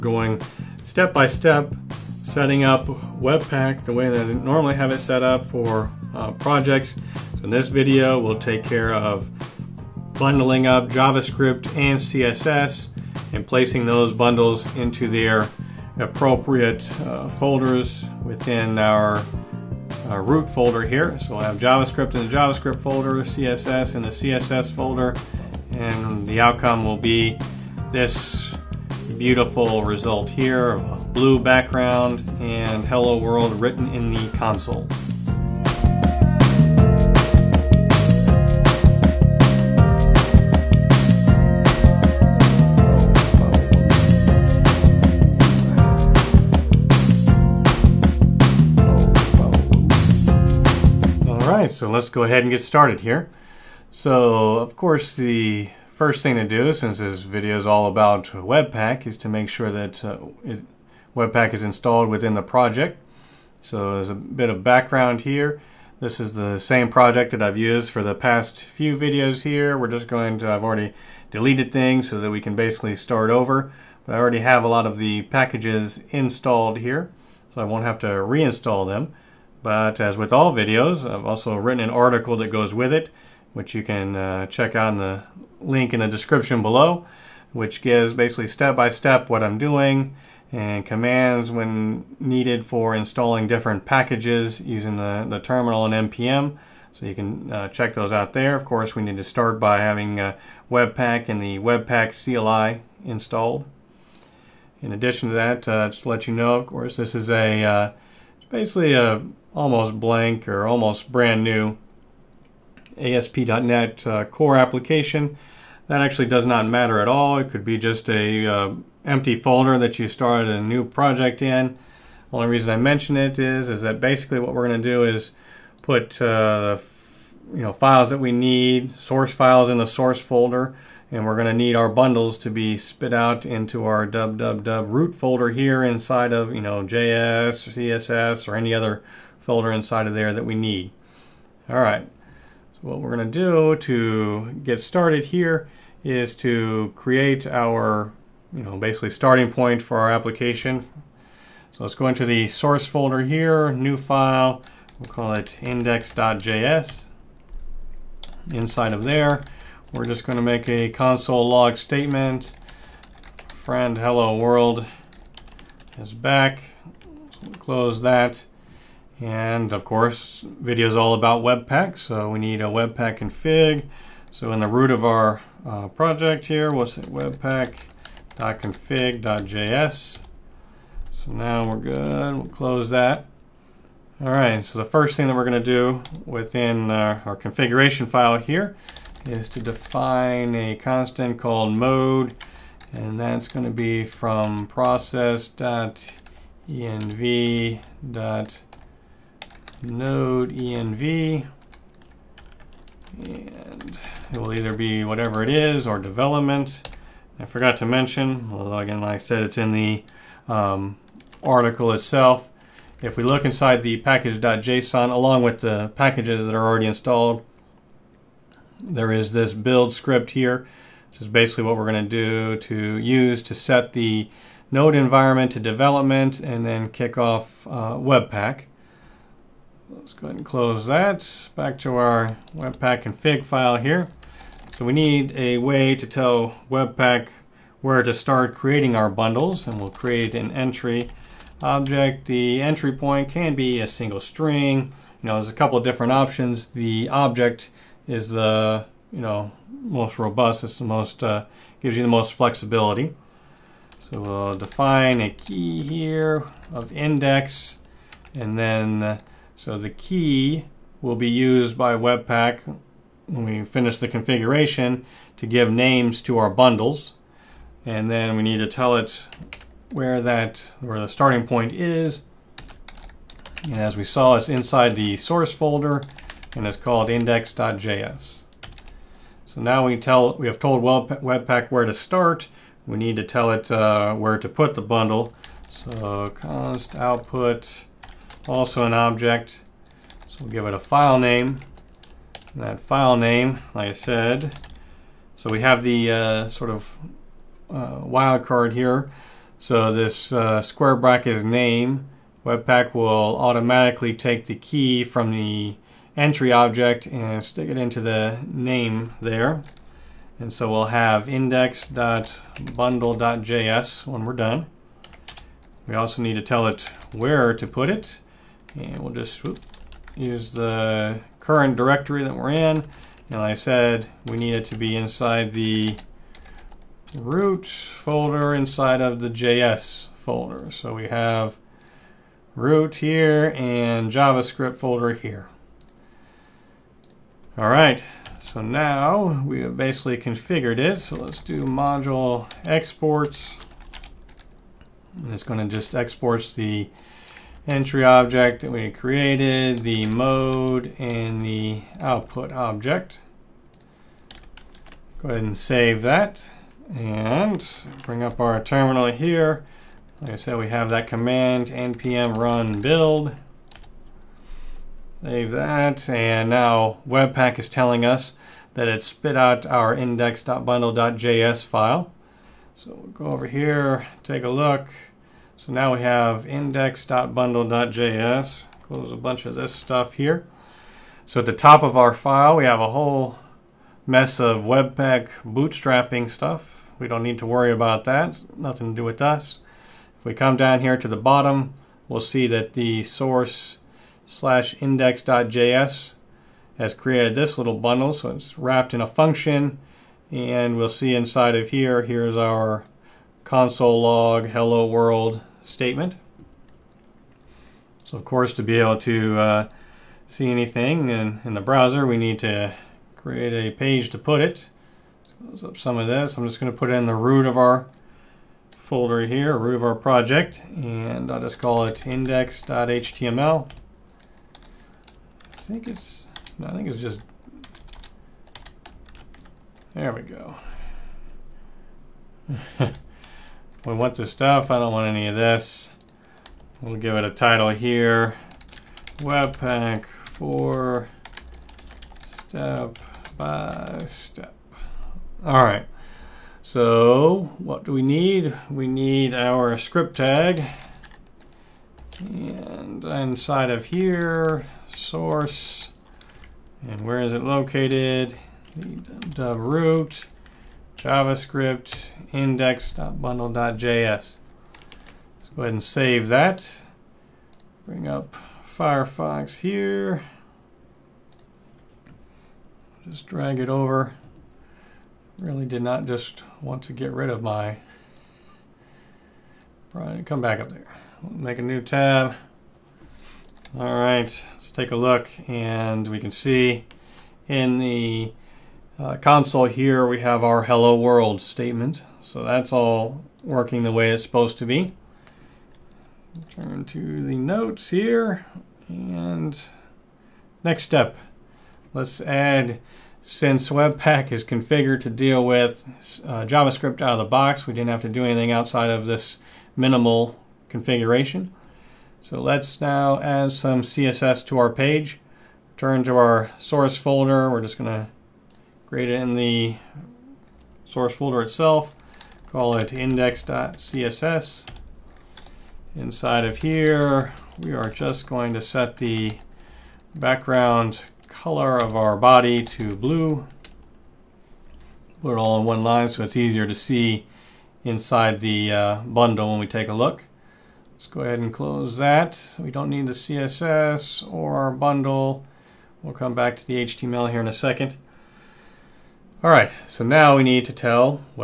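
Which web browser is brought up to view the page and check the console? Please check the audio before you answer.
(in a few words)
Firefox.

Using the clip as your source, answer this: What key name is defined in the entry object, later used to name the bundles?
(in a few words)
index.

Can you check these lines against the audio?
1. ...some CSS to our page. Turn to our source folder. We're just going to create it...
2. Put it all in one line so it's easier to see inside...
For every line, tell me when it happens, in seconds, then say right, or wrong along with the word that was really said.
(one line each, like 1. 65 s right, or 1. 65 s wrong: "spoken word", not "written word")
1. 513 s right
2. 535 s right.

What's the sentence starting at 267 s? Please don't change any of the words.
And then we need to tell it where that where the starting point is.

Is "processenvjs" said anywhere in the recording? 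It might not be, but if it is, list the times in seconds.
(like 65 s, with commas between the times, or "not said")
194 s.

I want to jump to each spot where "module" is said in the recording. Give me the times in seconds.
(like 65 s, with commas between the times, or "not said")
341 s.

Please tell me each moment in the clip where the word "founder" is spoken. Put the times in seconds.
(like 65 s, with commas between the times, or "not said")
not said.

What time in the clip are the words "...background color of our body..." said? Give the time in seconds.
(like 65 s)
530 s.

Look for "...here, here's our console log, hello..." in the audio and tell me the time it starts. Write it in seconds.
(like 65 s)
401 s.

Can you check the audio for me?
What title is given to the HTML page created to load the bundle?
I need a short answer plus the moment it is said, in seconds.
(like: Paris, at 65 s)
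Webpack for step by step, at 439 s.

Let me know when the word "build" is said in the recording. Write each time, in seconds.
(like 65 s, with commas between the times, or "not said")
219 s, 362 s.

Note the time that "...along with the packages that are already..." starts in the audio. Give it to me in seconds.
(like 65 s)
215 s.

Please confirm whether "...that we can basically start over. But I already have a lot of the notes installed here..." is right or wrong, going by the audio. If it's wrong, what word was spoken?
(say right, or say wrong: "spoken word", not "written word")
wrong: "packages", not "notes".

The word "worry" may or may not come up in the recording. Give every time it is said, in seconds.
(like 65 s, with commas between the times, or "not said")
387 s.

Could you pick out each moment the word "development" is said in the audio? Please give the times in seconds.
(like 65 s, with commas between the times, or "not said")
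205 s, 225 s.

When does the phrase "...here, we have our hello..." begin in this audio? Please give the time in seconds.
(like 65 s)
489 s.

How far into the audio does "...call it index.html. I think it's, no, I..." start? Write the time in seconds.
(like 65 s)
421 s.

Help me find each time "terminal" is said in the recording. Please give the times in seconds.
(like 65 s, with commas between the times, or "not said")
95 s, 358 s.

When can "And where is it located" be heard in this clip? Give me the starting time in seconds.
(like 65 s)
456 s.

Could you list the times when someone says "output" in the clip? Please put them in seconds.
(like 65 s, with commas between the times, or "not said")
286 s, 351 s.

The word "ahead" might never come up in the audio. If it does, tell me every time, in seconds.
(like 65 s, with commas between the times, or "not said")
52 s, 230 s, 355 s, 465 s, 541 s.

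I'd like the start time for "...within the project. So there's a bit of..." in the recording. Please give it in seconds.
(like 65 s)
62 s.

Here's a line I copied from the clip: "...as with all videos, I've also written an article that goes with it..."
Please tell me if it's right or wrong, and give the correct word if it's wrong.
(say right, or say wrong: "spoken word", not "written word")
right.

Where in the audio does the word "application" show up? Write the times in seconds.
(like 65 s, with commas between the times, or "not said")
114 s, 150 s.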